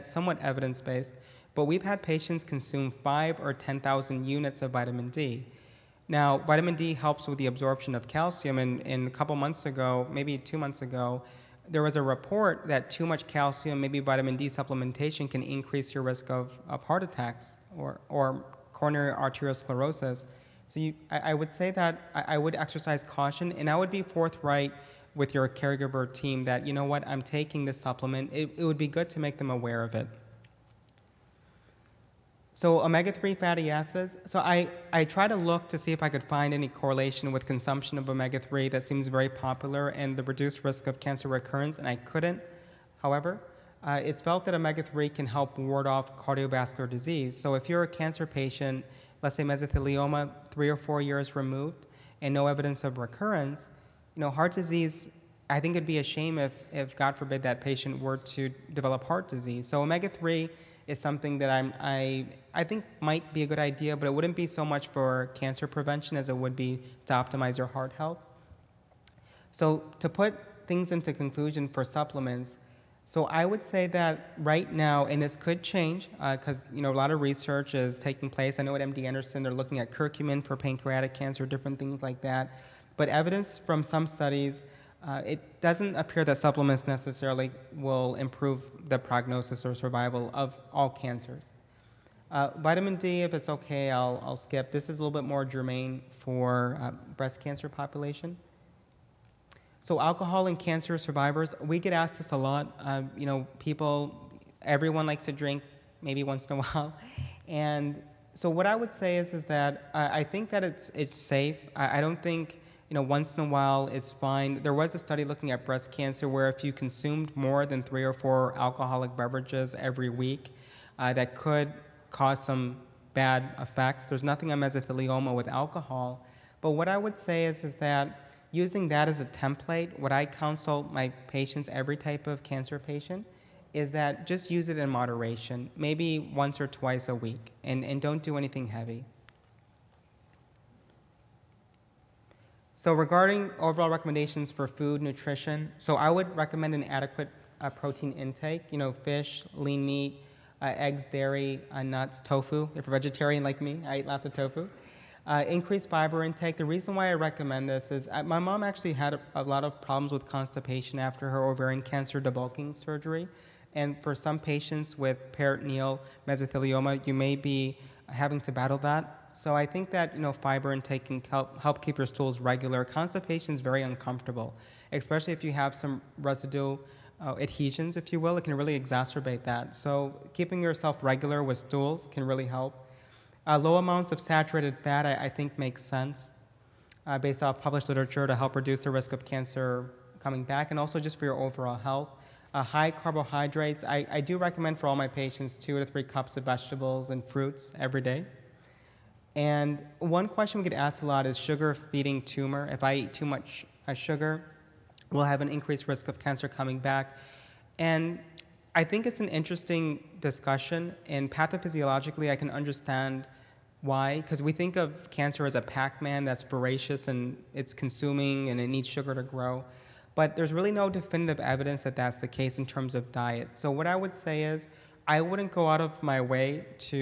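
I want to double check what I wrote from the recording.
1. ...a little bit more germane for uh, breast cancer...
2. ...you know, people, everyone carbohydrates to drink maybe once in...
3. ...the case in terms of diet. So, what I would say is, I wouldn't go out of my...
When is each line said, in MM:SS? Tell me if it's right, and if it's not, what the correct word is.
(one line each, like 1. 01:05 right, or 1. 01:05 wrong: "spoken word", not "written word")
1. 01:34 right
2. 01:43 wrong: "likes", not "carbohydrates"
3. 03:42 right.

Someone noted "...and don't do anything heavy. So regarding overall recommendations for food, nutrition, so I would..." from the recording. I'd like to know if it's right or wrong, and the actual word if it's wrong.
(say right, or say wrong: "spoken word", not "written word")
right.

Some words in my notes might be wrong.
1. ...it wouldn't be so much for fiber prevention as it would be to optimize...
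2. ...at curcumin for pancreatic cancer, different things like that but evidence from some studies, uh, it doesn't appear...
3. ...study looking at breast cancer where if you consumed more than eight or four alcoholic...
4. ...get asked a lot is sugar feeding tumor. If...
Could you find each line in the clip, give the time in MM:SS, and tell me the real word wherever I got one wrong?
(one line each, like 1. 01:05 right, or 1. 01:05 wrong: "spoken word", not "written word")
1. 01:04 wrong: "cancer", not "fiber"
2. 01:19 right
3. 01:54 wrong: "three", not "eight"
4. 03:20 right.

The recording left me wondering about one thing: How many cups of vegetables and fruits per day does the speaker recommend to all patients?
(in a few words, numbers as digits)
2 to 3.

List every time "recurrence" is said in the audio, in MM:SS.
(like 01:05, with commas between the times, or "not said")
00:41, 00:52.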